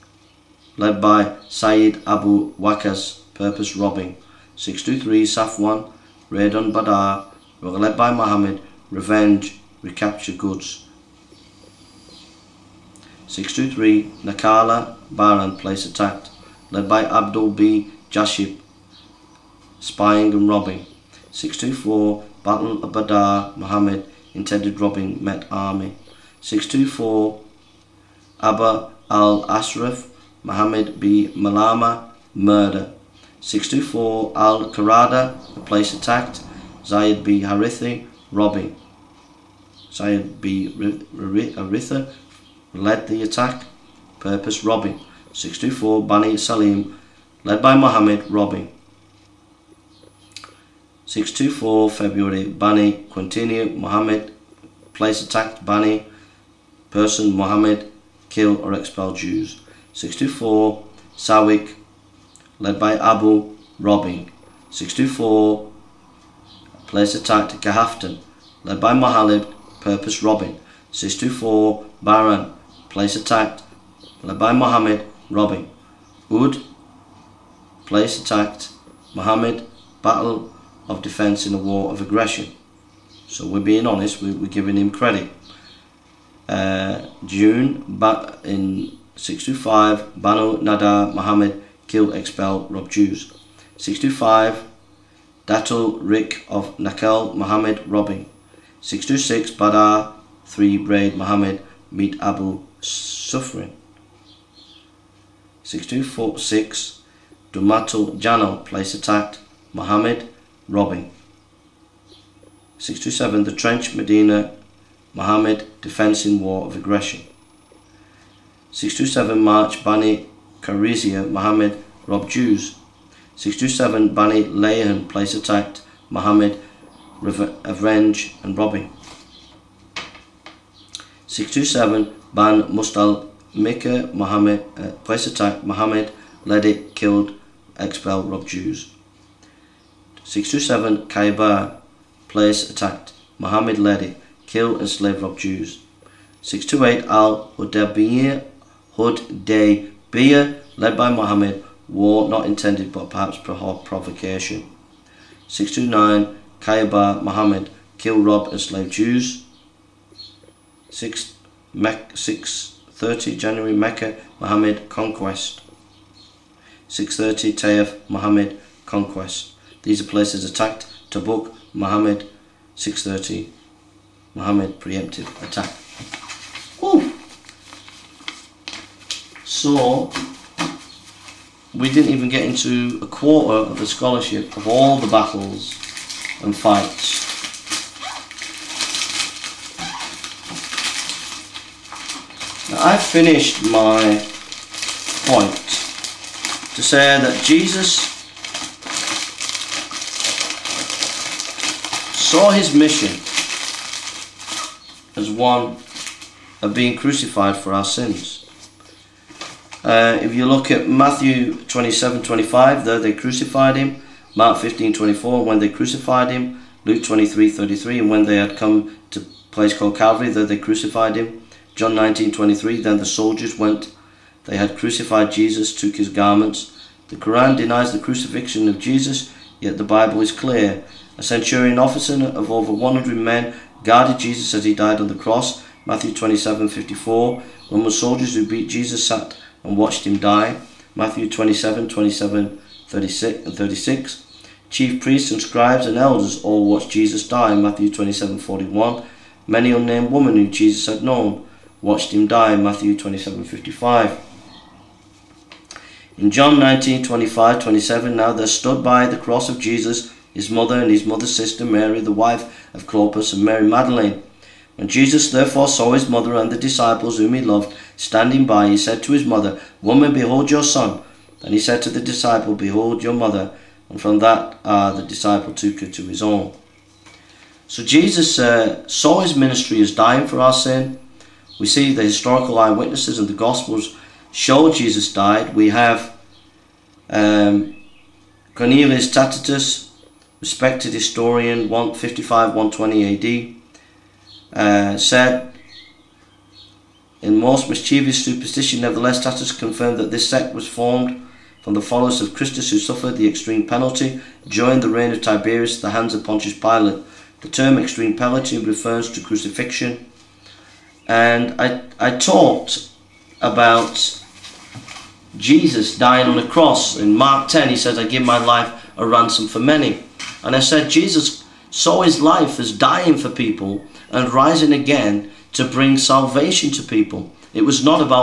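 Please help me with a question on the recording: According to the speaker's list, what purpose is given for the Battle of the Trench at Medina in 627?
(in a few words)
Defense in War of Aggression.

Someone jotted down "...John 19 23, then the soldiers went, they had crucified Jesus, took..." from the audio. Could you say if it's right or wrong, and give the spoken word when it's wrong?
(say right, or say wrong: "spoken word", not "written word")
right.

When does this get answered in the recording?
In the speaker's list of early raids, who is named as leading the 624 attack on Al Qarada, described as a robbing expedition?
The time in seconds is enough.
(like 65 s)
39 s.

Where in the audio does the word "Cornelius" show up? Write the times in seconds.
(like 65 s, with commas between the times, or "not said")
288 s.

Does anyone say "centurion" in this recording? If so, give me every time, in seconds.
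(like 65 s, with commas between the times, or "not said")
231 s.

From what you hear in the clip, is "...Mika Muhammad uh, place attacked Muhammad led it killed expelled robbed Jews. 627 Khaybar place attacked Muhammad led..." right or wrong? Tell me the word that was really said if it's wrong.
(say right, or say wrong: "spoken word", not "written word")
right.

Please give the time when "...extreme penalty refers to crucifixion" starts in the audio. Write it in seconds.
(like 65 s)
307 s.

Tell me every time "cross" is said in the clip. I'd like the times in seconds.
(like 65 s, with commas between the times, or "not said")
235 s, 259 s, 316 s.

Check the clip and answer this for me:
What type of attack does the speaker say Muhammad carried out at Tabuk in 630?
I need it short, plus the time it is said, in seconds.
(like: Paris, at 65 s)
preemptive attack, at 174 s.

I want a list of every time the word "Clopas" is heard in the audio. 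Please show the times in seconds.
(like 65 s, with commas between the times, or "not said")
262 s.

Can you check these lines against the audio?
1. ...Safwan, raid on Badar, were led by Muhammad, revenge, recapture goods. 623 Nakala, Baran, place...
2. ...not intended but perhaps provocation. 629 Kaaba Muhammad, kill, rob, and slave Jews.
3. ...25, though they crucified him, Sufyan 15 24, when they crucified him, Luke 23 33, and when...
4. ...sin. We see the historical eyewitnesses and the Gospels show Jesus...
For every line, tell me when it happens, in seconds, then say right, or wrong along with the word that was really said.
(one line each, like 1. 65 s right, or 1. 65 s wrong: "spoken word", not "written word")
1. 5 s right
2. 152 s right
3. 212 s wrong: "Mark", not "Sufyan"
4. 280 s right.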